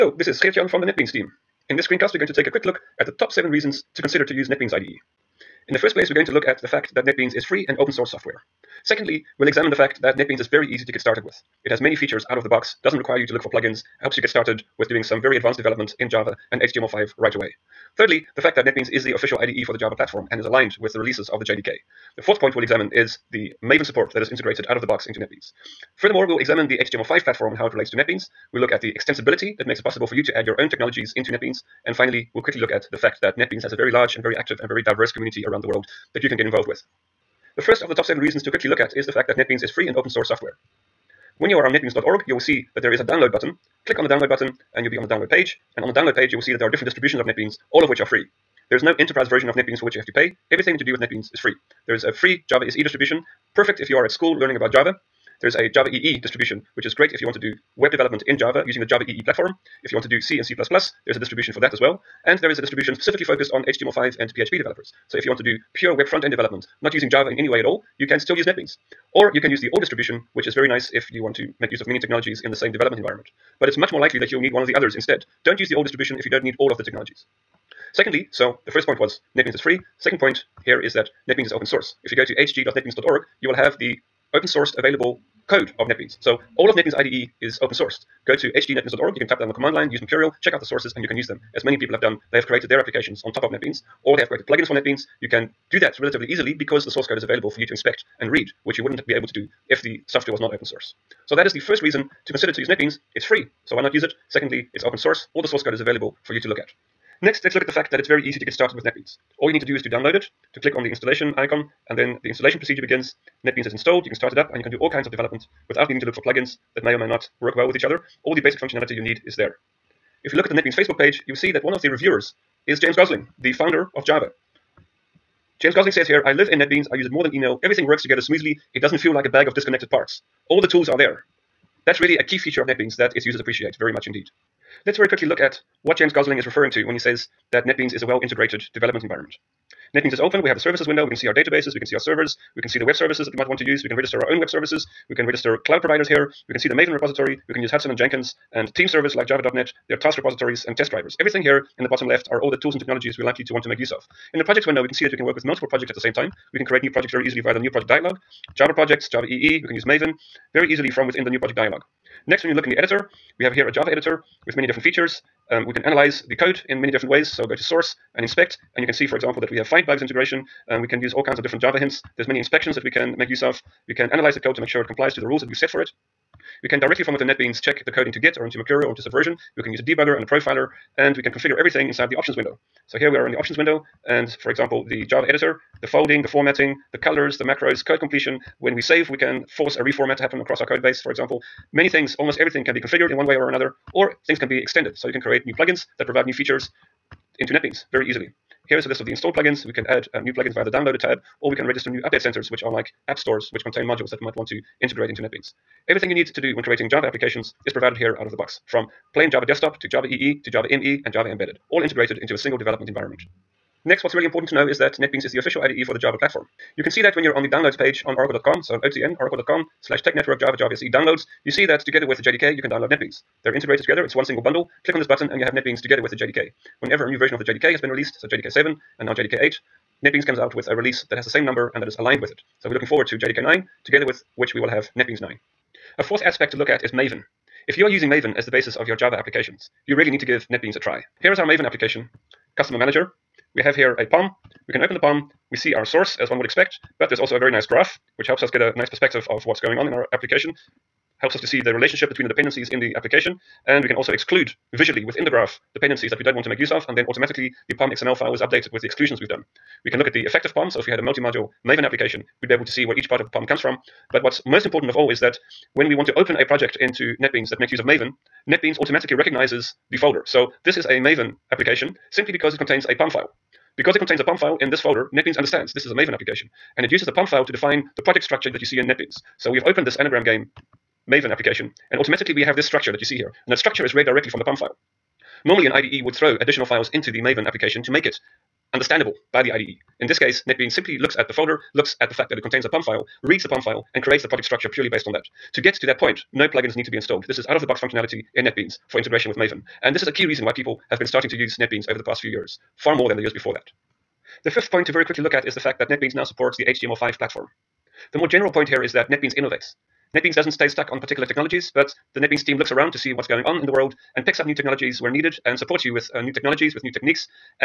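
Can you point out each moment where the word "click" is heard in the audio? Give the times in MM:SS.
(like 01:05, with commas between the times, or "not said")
00:43, 01:50, 03:44.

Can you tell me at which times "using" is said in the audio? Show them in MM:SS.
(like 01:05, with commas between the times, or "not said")
00:58, 01:06, 03:57.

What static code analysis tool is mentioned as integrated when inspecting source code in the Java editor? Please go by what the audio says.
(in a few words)
FindBugs.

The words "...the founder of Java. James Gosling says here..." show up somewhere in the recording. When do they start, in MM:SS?
02:03.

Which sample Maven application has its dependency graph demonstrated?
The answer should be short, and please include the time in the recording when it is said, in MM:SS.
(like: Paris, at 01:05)
Customer Manager, at 04:02.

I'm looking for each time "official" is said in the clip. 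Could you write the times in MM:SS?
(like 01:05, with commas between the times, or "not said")
00:19, 03:35.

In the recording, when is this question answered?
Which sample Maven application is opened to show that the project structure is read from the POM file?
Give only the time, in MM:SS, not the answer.
04:39.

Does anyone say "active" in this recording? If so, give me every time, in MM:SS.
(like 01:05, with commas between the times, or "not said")
00:34.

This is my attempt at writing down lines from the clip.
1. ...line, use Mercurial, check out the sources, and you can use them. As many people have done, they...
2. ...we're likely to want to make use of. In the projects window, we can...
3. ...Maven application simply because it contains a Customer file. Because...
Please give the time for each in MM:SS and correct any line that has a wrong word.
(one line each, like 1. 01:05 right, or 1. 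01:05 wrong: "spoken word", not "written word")
1. 01:29 right
2. 02:33 right
3. 04:30 wrong: "POM", not "Customer".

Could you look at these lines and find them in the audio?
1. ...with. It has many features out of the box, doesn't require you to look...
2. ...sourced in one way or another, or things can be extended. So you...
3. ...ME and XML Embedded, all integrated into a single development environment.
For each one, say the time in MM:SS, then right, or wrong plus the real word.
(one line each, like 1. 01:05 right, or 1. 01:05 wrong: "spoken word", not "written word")
1. 00:11 right
2. 03:12 wrong: "configured", not "sourced"
3. 03:30 wrong: "Java", not "XML".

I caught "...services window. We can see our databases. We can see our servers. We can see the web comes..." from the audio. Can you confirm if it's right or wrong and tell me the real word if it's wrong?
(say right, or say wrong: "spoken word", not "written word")
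wrong: "services", not "comes".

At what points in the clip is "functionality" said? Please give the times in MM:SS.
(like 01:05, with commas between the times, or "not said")
01:58, 04:57.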